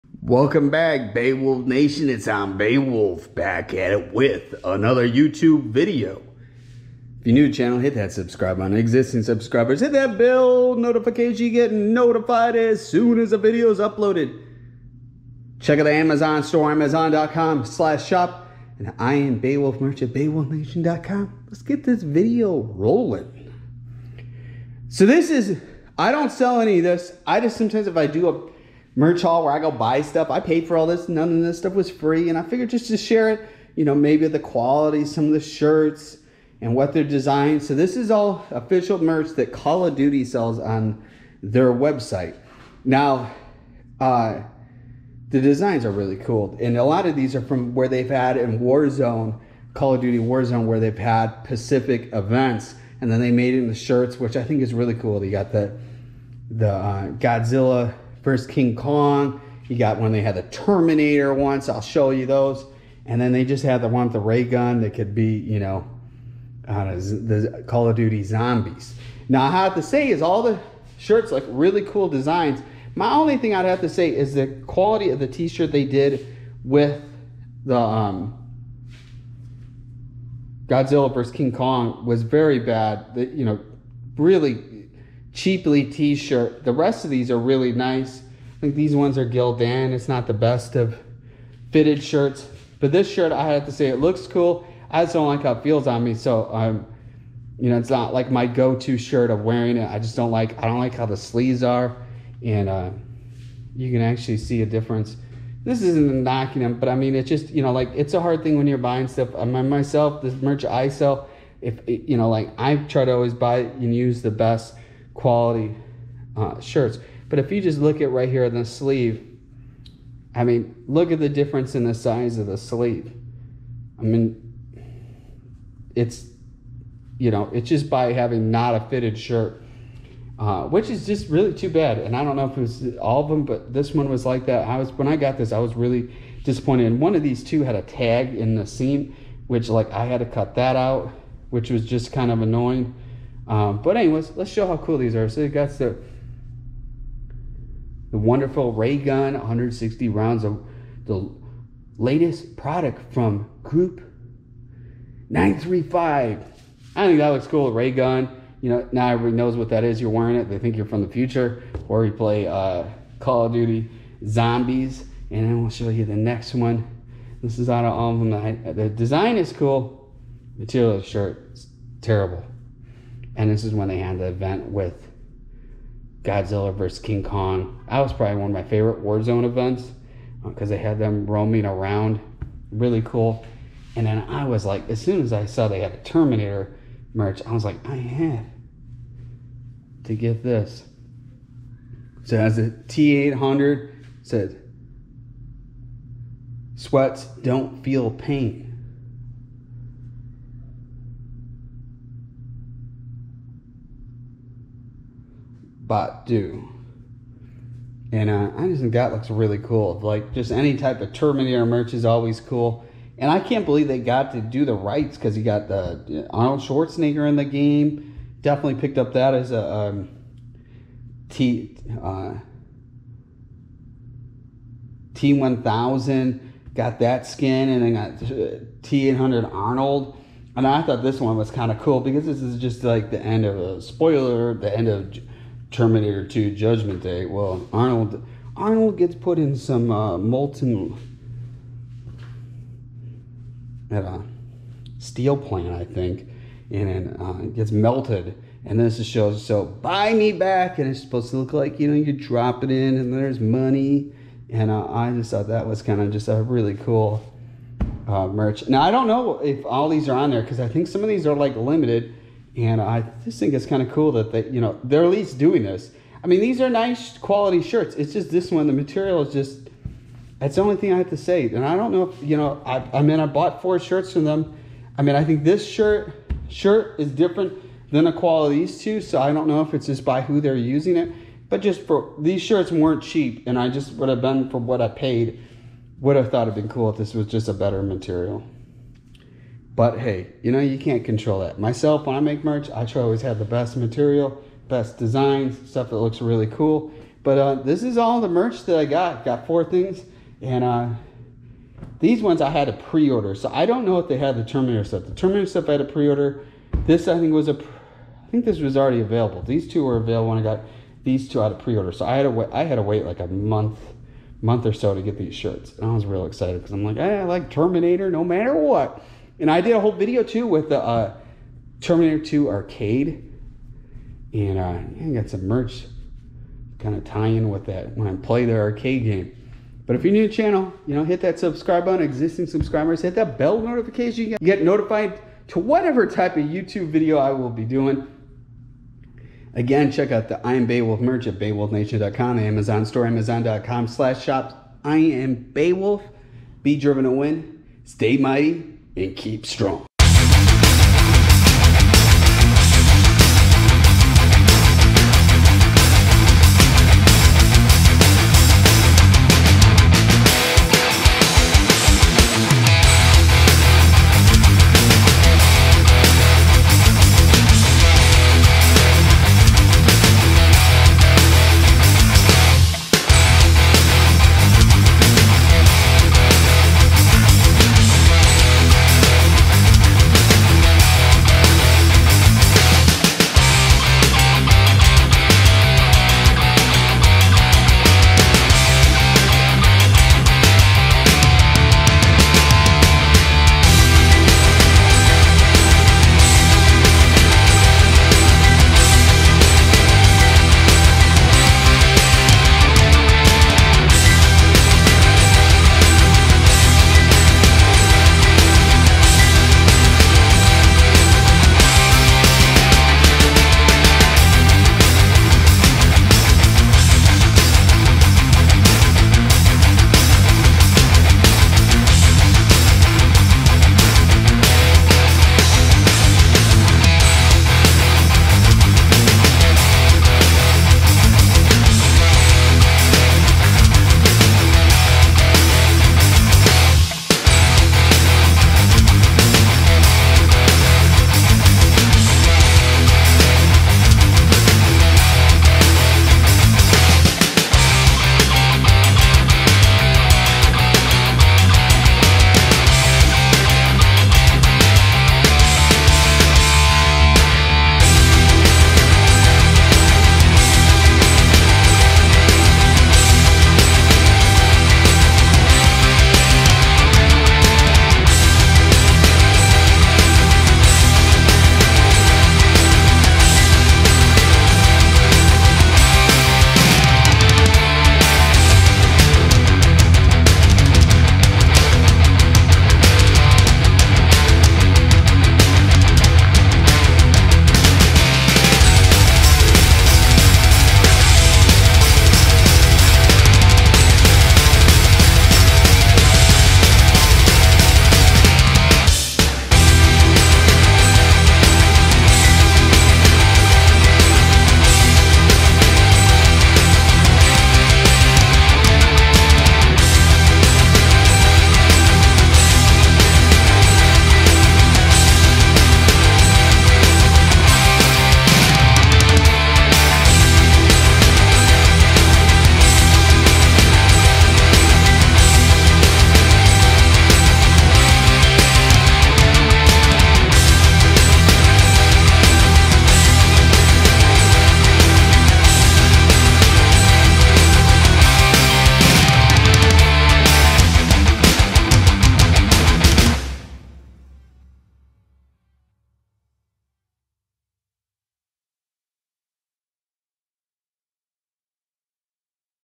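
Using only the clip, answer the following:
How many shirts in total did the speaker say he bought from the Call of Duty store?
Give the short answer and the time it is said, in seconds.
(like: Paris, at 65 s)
4, at 273 s.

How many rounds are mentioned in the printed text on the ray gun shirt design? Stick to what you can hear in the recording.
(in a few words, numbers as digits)
160.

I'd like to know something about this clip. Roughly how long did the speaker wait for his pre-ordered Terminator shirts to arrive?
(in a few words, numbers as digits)
a month.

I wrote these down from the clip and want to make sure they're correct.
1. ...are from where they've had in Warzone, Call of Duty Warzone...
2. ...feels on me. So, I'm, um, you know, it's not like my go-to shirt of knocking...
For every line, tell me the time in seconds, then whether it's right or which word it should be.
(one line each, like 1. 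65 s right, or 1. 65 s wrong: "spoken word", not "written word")
1. 47 s right
2. 95 s wrong: "wearing", not "knocking".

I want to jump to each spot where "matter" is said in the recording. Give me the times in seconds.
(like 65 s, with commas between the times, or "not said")
318 s.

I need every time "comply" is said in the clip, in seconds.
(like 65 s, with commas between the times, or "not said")
not said.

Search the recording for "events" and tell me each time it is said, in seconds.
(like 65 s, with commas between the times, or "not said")
52 s, 174 s, 179 s.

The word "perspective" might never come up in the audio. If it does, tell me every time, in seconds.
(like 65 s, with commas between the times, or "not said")
not said.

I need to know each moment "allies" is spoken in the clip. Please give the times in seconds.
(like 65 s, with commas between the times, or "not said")
not said.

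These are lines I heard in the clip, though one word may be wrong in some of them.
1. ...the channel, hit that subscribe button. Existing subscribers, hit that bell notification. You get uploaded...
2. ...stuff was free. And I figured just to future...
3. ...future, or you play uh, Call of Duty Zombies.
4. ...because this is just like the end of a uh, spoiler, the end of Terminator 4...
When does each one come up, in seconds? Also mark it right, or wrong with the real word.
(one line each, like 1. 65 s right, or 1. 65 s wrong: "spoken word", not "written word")
1. 7 s wrong: "notified", not "uploaded"
2. 31 s wrong: "share", not "future"
3. 161 s right
4. 232 s wrong: "2", not "4".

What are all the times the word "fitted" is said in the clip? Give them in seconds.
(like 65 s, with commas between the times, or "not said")
91 s, 128 s.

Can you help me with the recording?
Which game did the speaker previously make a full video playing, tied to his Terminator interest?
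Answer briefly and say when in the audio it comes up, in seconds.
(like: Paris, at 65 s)
Terminator 2 arcade, at 321 s.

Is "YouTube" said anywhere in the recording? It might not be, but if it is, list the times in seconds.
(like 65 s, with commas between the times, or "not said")
5 s, 336 s.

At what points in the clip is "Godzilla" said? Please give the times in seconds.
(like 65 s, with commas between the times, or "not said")
57 s, 80 s, 176 s.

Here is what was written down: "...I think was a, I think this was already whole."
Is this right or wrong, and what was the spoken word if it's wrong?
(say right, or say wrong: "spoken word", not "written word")
wrong: "available", not "whole".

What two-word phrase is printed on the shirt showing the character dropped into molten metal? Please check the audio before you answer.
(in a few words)
buy me back.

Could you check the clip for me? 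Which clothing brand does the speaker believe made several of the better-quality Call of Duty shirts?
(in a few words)
Gildan.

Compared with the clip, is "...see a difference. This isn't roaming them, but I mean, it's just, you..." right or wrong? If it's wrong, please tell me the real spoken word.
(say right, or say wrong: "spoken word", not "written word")
wrong: "knocking", not "roaming".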